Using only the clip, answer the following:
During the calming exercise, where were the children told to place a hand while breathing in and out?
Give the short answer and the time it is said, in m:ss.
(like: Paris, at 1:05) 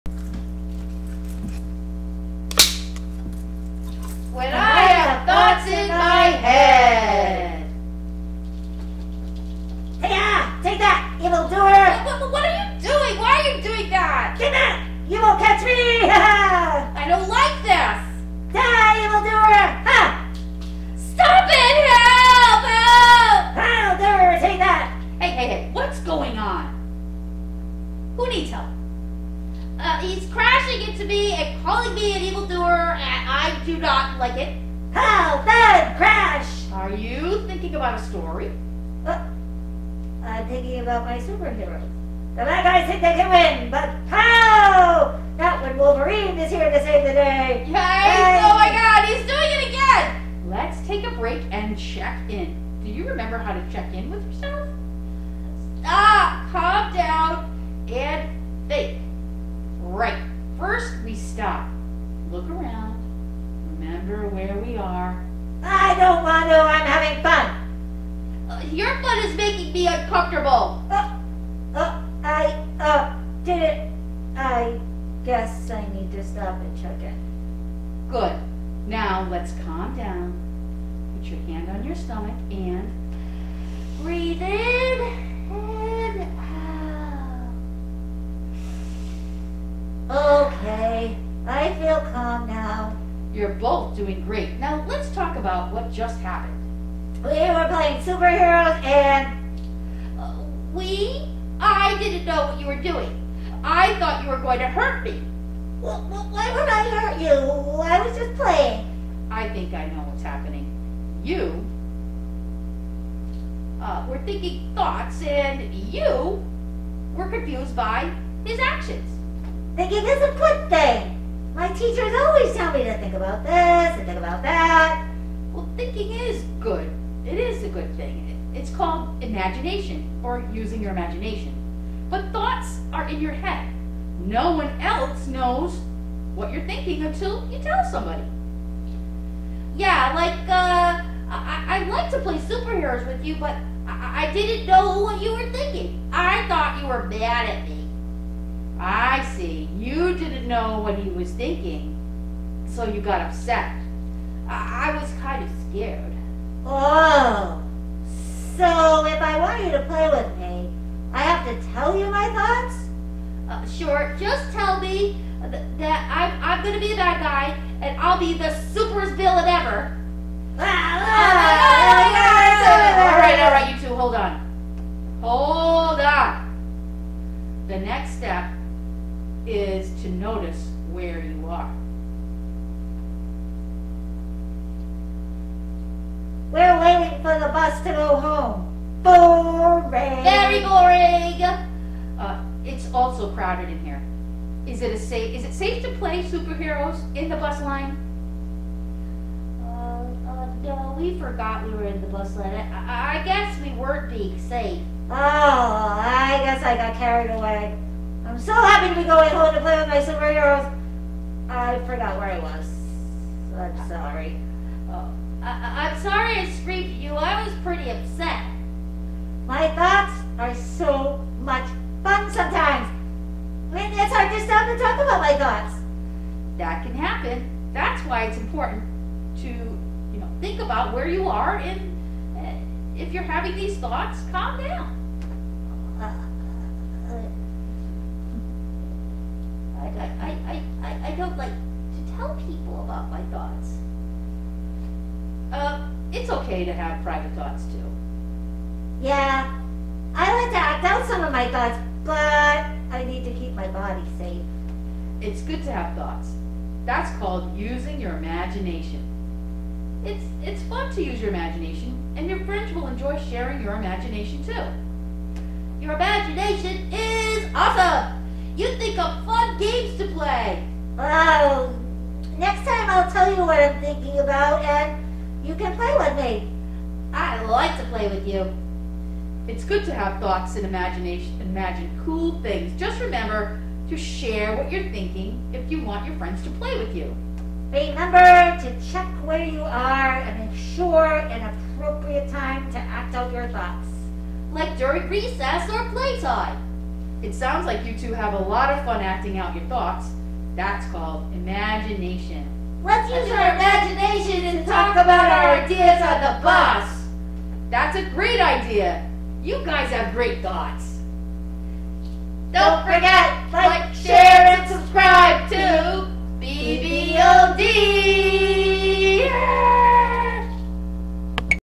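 stomach, at 1:21.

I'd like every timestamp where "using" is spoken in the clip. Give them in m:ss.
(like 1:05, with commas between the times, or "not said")
2:10, 4:17.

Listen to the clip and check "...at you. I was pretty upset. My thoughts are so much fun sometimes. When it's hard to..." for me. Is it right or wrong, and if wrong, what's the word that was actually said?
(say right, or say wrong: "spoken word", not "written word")
right.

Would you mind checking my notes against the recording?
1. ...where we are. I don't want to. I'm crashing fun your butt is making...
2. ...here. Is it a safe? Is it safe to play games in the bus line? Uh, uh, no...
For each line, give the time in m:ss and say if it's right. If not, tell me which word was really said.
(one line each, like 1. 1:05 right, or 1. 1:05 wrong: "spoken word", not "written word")
1. 1:04 wrong: "having", not "crashing"
2. 3:13 wrong: "superheroes", not "games".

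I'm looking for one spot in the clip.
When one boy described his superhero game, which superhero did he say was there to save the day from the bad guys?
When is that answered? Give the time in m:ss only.
0:45.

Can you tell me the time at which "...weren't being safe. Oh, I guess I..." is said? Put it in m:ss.
3:23.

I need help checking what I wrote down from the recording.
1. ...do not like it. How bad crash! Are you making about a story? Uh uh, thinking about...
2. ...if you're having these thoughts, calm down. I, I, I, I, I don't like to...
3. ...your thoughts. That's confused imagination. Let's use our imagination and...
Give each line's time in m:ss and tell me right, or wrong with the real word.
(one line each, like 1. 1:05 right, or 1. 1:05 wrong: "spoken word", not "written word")
1. 0:33 wrong: "thinking", not "making"
2. 3:53 right
3. 4:59 wrong: "called", not "confused".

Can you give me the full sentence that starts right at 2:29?
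You didn't know what he was thinking, so you got upset.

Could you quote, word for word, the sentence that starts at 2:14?
No one else knows what you're thinking until you tell somebody.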